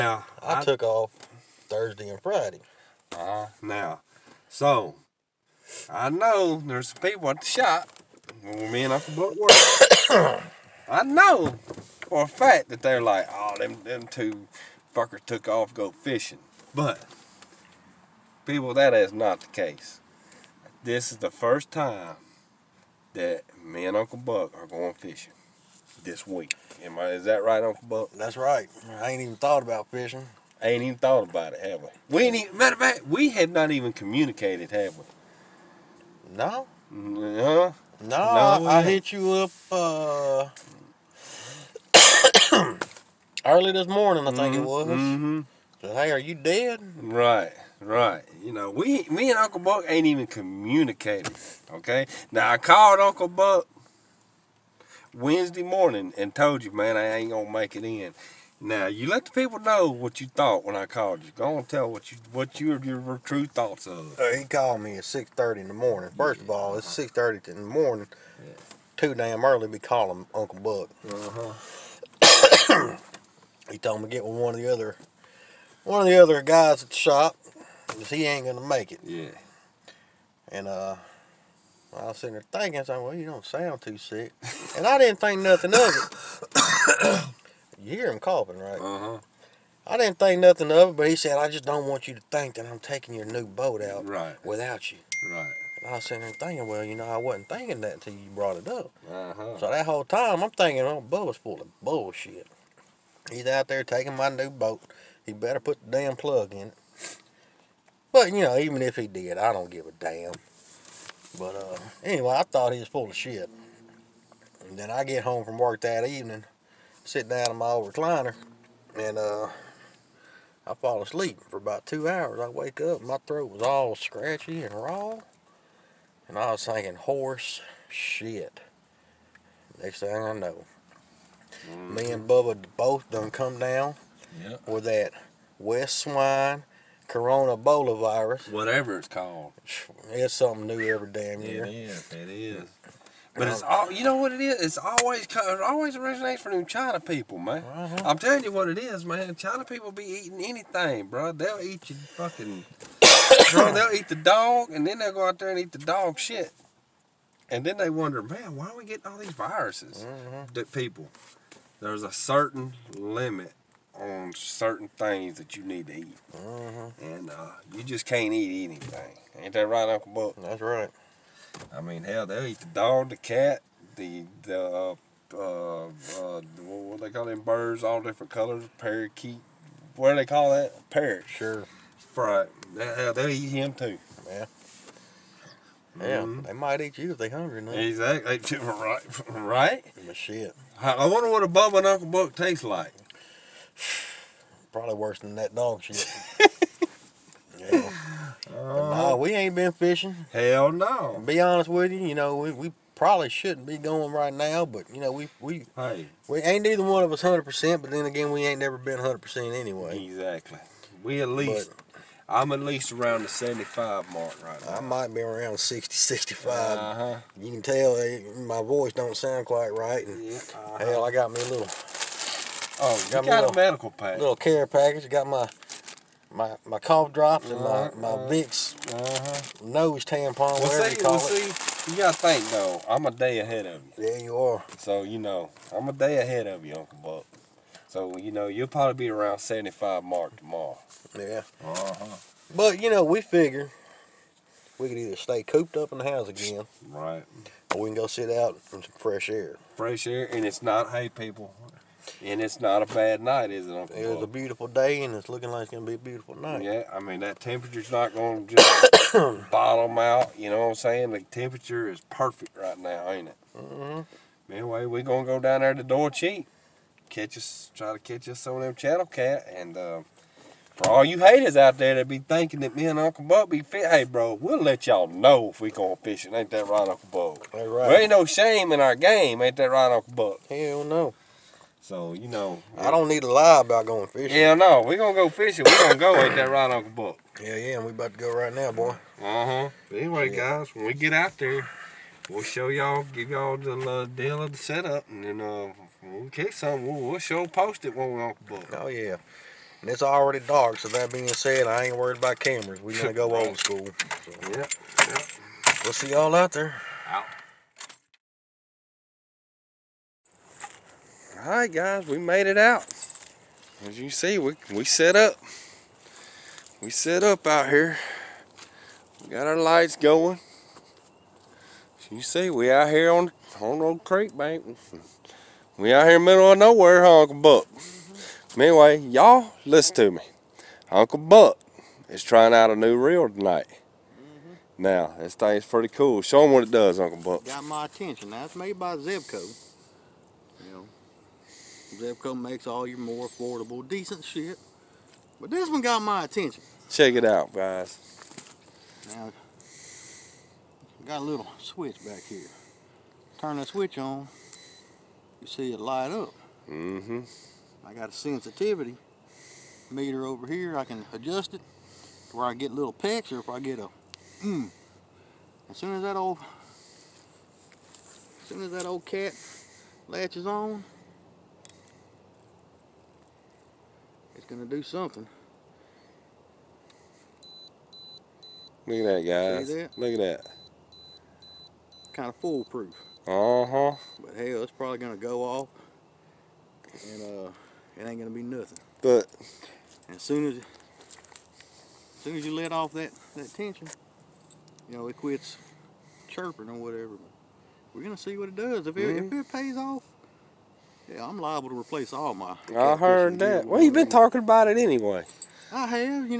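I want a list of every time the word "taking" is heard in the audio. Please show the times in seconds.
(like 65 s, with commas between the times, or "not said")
92 s, 103 s.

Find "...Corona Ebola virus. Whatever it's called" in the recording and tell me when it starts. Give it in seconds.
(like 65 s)
137 s.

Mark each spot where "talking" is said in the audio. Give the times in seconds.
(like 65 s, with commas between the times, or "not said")
404 s.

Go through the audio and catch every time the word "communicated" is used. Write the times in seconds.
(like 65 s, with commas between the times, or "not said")
33 s, 50 s.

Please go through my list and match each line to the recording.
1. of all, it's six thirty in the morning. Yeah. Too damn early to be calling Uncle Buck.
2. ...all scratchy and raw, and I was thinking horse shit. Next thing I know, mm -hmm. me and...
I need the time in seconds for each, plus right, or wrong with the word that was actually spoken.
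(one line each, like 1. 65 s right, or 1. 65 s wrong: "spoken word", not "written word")
1. 66 s right
2. 123 s right.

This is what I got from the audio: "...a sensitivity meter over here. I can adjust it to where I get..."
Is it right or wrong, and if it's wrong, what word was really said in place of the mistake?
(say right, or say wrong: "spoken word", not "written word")
right.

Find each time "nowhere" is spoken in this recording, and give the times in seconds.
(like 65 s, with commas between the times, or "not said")
326 s.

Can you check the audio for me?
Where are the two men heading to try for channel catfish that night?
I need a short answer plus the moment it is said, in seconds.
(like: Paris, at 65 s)
Dorcheat, at 265 s.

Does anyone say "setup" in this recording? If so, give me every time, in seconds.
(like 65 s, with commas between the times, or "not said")
294 s.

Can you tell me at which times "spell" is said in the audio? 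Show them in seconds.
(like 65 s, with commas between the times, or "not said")
not said.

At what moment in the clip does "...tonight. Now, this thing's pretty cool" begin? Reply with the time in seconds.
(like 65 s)
333 s.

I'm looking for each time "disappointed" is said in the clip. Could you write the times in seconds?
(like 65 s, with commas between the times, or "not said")
not said.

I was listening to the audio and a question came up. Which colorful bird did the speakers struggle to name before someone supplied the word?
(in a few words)
Parrot.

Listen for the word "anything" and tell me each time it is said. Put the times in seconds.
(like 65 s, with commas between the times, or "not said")
150 s, 168 s.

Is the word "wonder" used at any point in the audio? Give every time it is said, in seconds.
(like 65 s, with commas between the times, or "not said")
157 s, 191 s.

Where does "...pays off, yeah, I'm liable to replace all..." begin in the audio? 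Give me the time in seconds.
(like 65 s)
399 s.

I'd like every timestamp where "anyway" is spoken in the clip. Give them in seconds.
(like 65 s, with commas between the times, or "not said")
112 s, 209 s, 264 s, 289 s, 328 s, 404 s.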